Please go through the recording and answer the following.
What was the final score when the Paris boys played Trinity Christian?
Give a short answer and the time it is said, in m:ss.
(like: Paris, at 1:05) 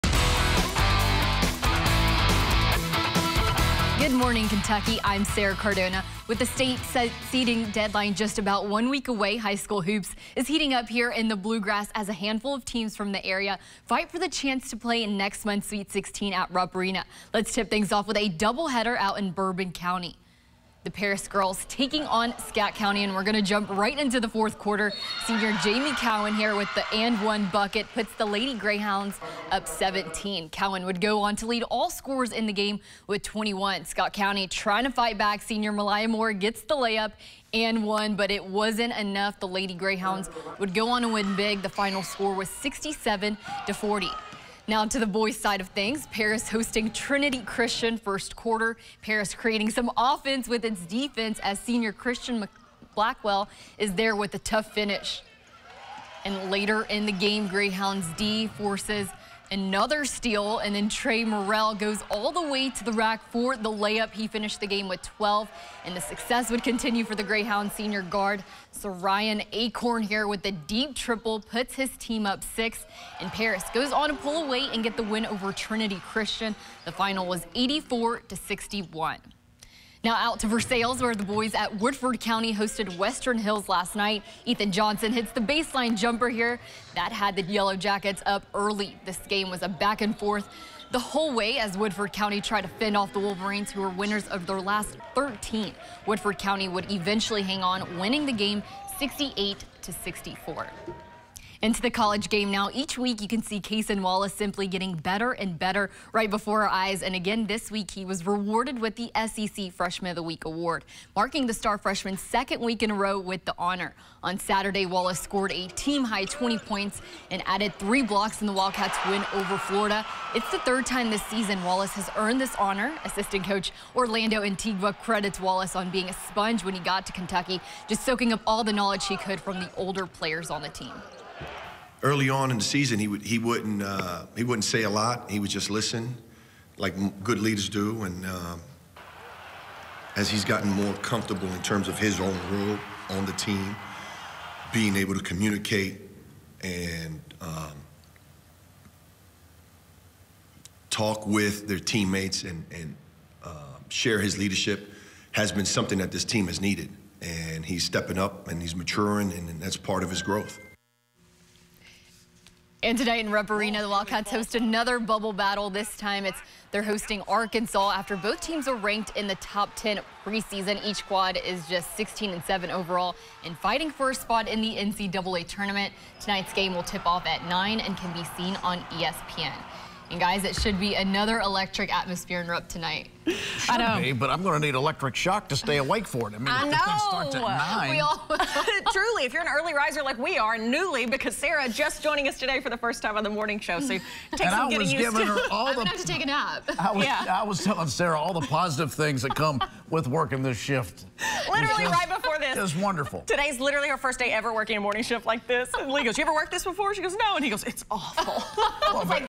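84 to 61, at 1:17.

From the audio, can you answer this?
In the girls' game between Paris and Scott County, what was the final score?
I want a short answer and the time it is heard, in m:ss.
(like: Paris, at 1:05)
67 to 40, at 0:42.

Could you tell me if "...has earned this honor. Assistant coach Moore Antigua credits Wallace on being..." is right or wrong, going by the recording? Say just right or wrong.
wrong.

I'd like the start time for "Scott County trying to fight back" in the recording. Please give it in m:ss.
0:33.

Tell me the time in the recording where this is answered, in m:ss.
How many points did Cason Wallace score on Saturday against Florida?
1:56.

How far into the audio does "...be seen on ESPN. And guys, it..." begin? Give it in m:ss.
2:58.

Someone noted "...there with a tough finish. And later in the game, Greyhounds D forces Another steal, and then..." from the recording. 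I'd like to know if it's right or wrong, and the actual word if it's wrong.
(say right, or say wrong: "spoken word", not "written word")
right.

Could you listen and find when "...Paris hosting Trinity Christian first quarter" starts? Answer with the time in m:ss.
0:46.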